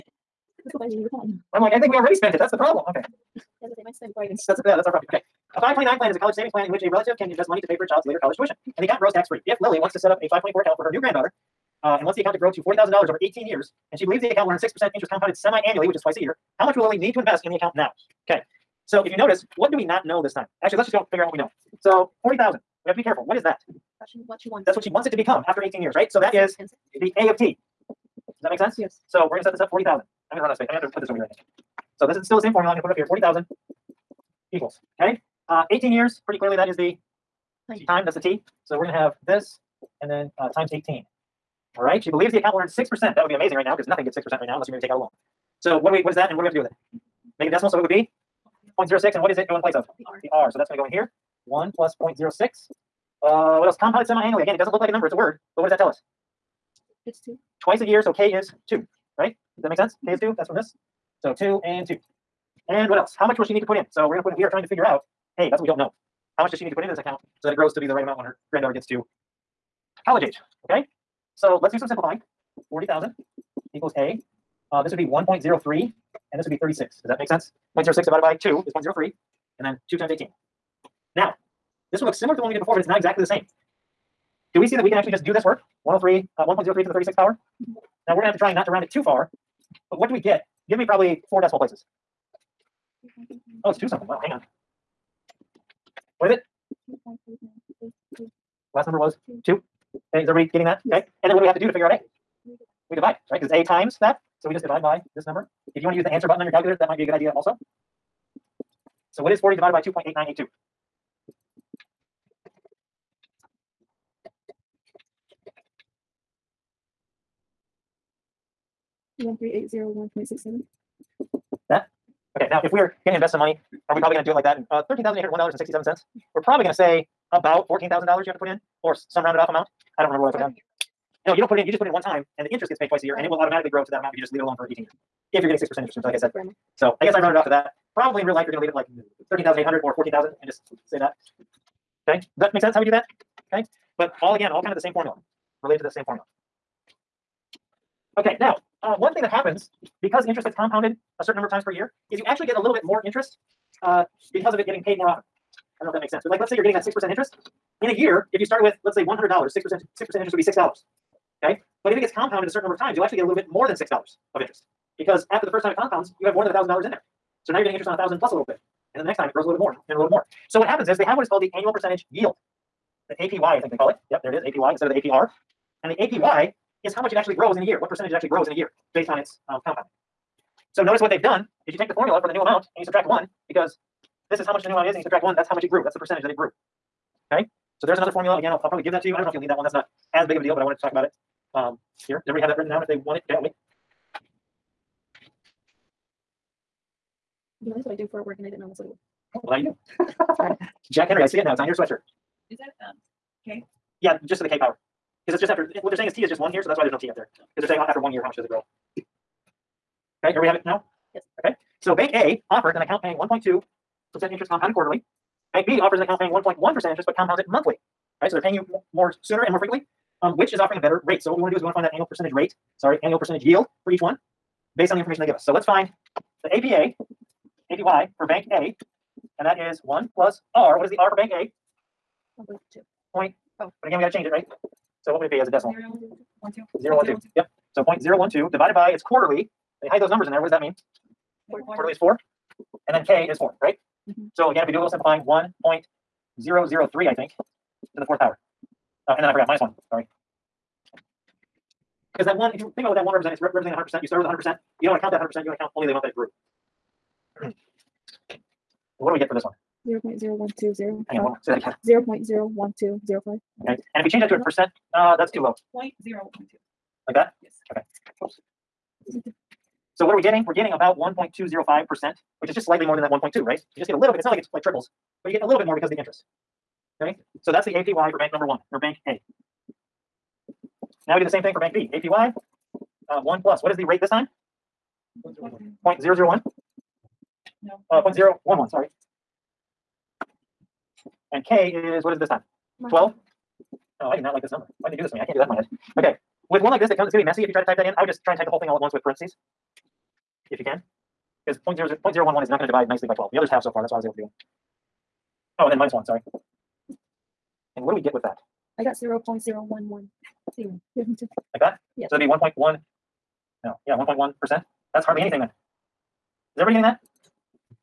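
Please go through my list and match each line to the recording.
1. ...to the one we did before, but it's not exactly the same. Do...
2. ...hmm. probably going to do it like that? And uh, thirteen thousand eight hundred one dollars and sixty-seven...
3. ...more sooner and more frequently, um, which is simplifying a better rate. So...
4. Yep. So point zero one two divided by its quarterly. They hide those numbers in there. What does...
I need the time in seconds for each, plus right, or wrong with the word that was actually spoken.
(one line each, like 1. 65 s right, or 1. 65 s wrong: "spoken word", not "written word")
1. 82 s right
2. 123 s right
3. 218 s wrong: "offering", not "simplifying"
4. 237 s right.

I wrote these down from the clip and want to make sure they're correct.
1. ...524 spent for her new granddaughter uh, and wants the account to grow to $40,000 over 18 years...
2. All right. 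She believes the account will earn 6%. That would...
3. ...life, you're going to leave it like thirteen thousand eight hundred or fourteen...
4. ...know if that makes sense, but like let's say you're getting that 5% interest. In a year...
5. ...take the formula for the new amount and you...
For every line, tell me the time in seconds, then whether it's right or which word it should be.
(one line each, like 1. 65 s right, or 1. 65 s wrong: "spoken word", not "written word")
1. 10 s wrong: "account", not "spent"
2. 41 s right
3. 138 s right
4. 155 s wrong: "6", not "5"
5. 181 s right.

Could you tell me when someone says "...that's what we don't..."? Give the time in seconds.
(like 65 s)
65 s.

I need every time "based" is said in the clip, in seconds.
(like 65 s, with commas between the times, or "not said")
178 s, 224 s.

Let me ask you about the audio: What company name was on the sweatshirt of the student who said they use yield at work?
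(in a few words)
Jack Henry.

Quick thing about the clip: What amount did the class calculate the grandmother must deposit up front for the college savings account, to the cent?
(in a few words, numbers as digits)
$13,801.67.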